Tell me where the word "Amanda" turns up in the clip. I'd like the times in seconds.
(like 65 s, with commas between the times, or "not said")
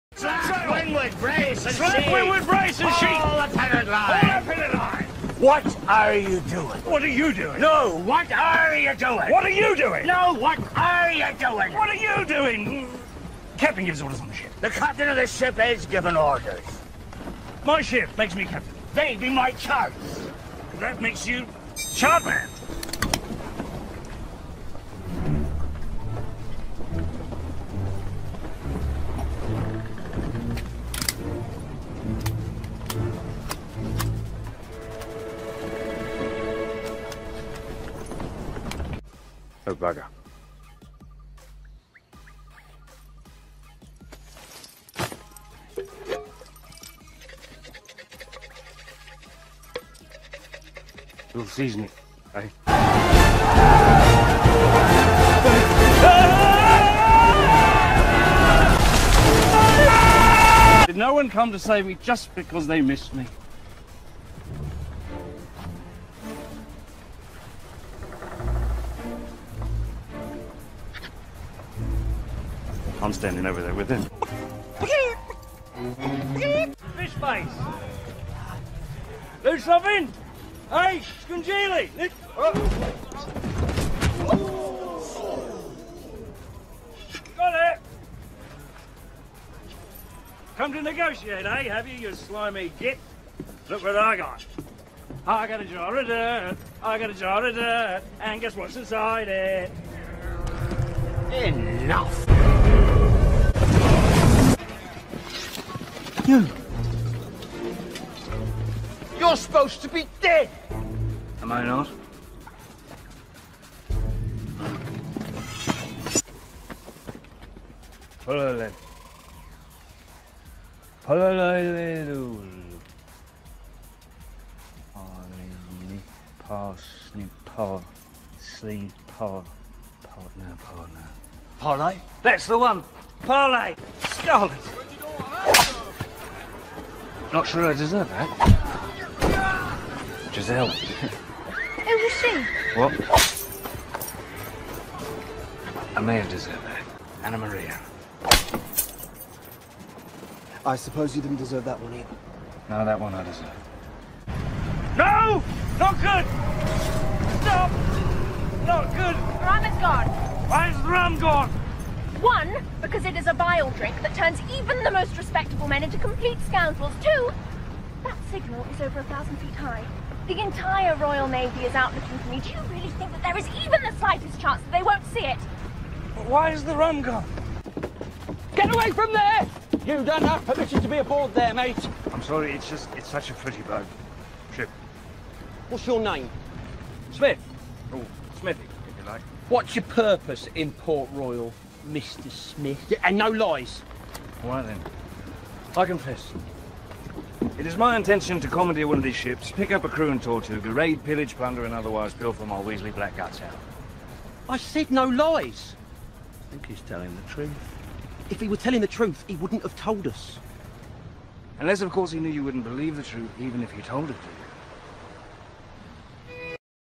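145 s.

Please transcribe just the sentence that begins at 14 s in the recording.
The captain of the ship is given orders.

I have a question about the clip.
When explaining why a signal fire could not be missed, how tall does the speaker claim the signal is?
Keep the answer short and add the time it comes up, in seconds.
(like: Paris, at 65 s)
over 1000 feet, at 168 s.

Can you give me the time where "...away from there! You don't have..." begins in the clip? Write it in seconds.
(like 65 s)
178 s.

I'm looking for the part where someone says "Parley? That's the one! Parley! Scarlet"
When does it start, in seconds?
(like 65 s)
131 s.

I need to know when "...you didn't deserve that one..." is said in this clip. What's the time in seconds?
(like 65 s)
151 s.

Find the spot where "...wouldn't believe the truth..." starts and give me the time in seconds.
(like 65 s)
212 s.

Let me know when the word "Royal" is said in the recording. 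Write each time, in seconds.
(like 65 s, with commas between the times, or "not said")
170 s, 191 s.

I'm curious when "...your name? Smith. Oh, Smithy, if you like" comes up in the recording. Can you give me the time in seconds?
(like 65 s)
185 s.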